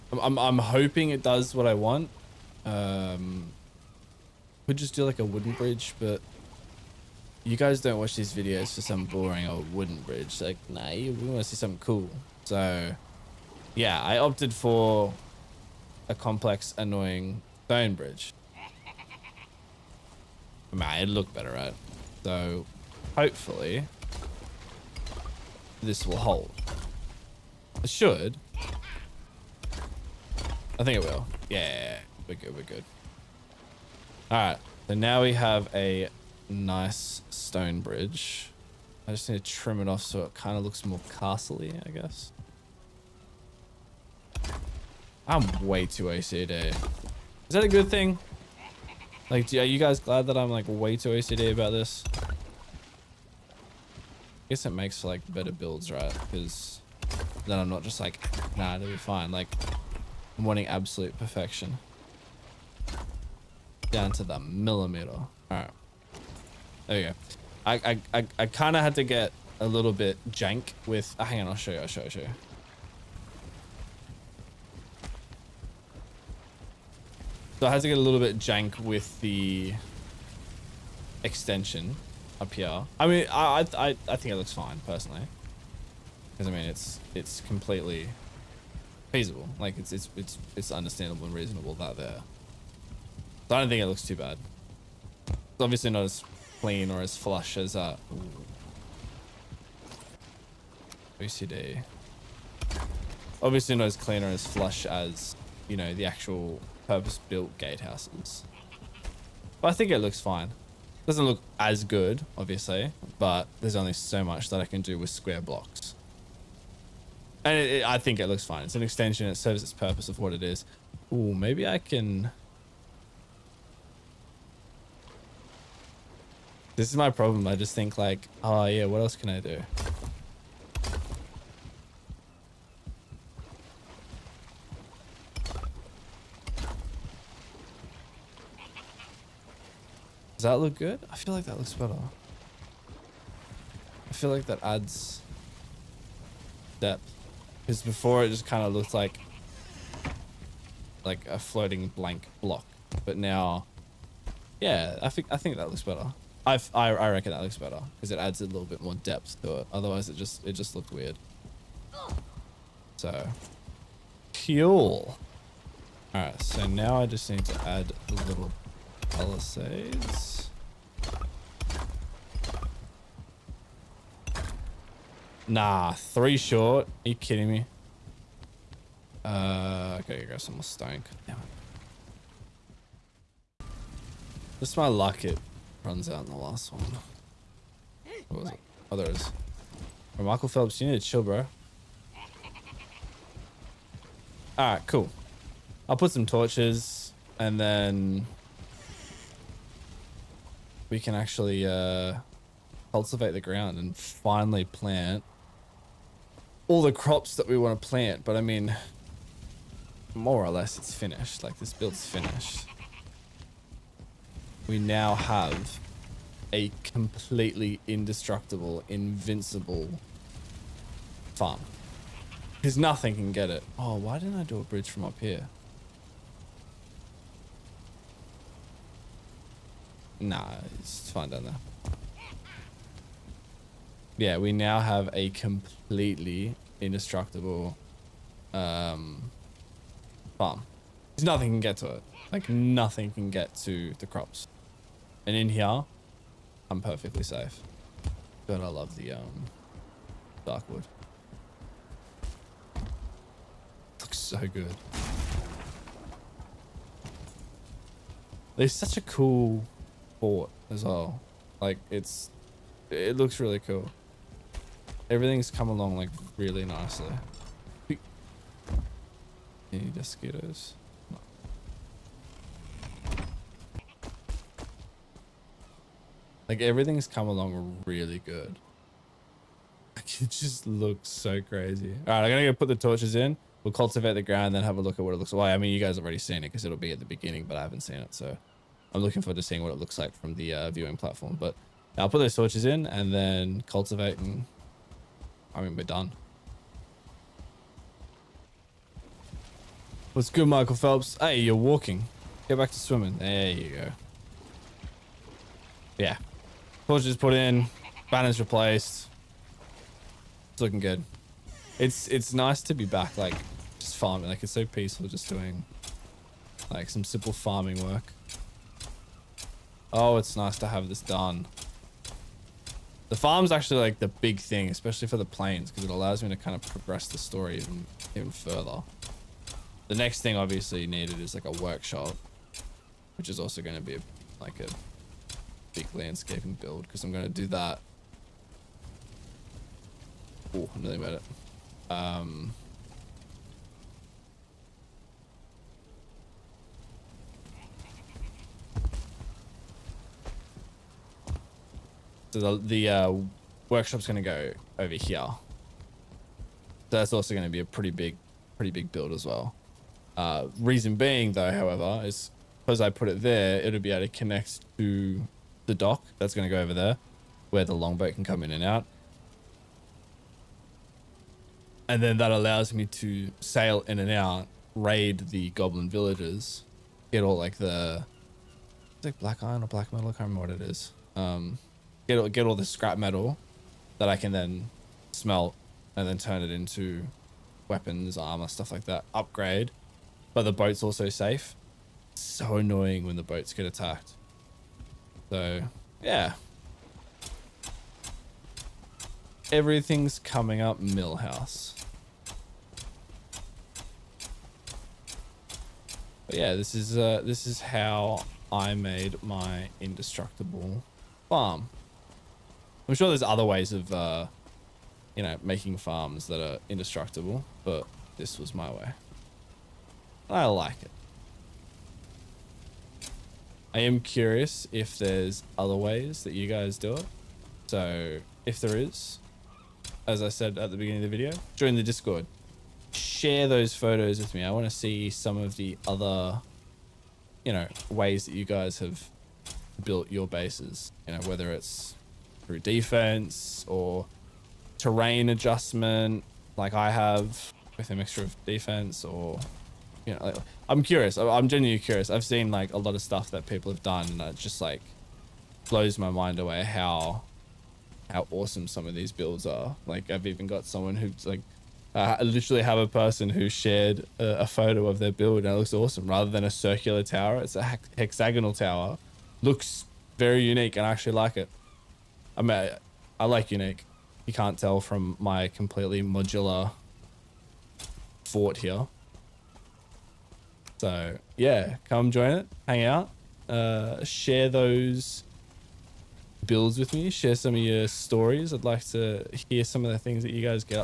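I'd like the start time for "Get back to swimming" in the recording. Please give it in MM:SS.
05:02.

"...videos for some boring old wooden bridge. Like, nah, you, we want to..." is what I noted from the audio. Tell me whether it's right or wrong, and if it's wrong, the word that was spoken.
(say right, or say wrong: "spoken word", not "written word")
right.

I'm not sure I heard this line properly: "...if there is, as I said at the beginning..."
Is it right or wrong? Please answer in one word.
right.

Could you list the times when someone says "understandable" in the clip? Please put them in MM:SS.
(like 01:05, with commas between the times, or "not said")
01:30.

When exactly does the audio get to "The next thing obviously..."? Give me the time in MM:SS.
05:29.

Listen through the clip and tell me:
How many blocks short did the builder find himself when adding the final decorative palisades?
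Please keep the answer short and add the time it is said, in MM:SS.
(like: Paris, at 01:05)
3, at 02:55.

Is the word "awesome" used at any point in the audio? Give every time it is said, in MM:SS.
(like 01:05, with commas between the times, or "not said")
07:38, 07:45.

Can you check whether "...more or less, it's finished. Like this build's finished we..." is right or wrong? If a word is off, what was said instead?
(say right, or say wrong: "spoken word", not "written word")
right.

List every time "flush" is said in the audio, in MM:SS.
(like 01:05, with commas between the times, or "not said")
01:37, 01:44.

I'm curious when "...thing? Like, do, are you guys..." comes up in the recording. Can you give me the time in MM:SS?
00:47.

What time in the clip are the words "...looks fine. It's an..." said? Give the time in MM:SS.
01:58.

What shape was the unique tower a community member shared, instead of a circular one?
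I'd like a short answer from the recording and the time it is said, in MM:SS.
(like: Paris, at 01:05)
Hexagonal, at 07:47.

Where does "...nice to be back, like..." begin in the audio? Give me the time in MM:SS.
05:12.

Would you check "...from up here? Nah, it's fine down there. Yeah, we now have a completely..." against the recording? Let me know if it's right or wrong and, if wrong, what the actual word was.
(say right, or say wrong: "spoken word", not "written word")
right.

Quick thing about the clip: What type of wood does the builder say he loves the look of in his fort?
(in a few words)
Dark wood.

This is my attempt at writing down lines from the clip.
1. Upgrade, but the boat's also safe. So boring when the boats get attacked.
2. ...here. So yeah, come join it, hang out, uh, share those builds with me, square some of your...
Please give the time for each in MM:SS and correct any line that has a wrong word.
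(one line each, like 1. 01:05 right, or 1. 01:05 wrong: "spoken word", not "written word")
1. 06:29 wrong: "annoying", not "boring"
2. 07:58 wrong: "share", not "square".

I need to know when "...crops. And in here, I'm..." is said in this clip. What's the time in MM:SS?
04:04.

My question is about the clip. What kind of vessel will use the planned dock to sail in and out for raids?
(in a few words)
Longboat.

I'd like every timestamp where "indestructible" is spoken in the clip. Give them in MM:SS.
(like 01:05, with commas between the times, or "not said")
03:37, 03:56, 06:49, 06:56.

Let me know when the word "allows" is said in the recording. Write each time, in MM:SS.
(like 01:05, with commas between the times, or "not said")
05:25, 06:12.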